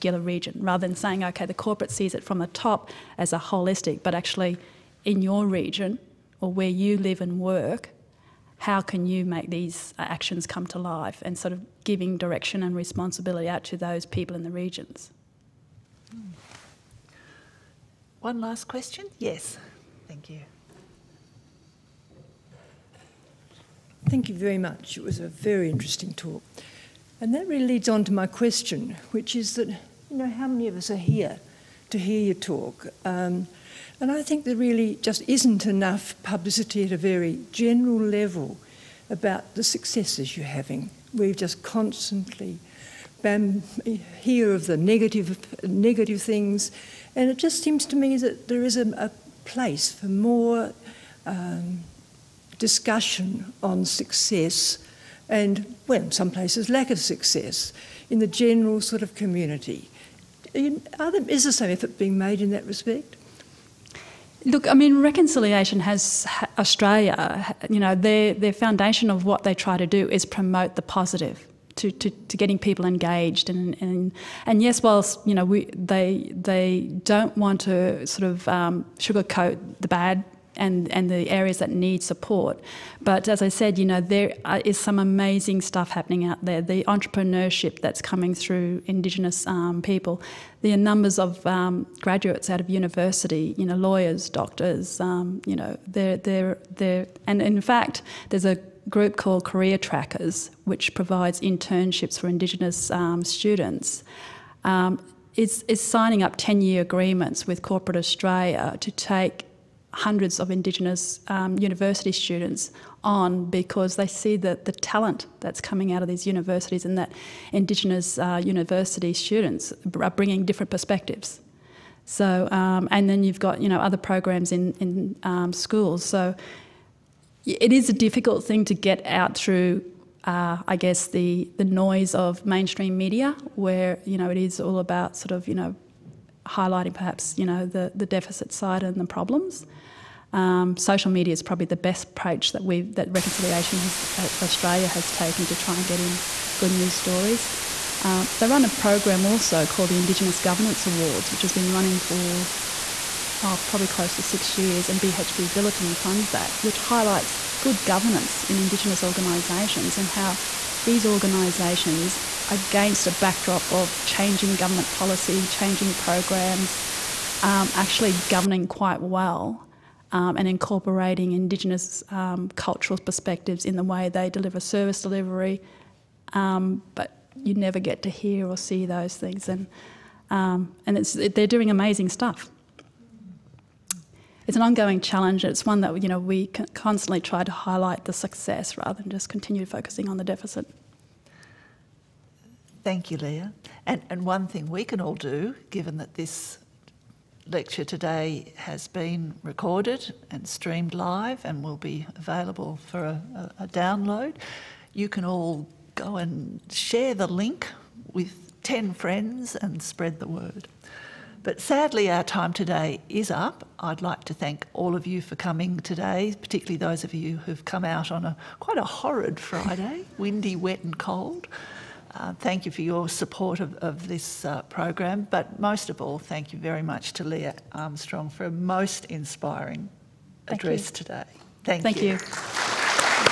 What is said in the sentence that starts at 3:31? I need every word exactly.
But sadly, our time today is up.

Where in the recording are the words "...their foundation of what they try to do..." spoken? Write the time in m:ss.
1:08.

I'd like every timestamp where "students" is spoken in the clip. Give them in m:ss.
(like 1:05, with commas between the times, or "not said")
1:43, 1:52, 1:59.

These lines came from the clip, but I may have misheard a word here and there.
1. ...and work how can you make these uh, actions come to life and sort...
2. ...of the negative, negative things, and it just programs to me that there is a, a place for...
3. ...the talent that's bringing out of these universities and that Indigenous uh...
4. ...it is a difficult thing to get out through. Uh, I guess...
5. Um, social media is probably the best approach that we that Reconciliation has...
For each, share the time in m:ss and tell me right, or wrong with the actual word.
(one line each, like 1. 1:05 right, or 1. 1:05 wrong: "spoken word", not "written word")
1. 0:07 right
2. 0:44 wrong: "seems", not "programs"
3. 1:54 wrong: "coming", not "bringing"
4. 2:07 right
5. 2:20 right.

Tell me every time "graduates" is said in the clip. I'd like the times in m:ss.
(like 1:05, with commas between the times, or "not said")
1:32.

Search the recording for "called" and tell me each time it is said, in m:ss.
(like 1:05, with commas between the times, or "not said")
1:39, 2:29.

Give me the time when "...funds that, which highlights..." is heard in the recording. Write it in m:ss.
2:35.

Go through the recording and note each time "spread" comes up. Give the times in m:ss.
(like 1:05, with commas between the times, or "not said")
3:29.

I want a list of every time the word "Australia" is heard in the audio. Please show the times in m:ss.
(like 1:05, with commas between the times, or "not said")
1:06, 1:47, 2:24.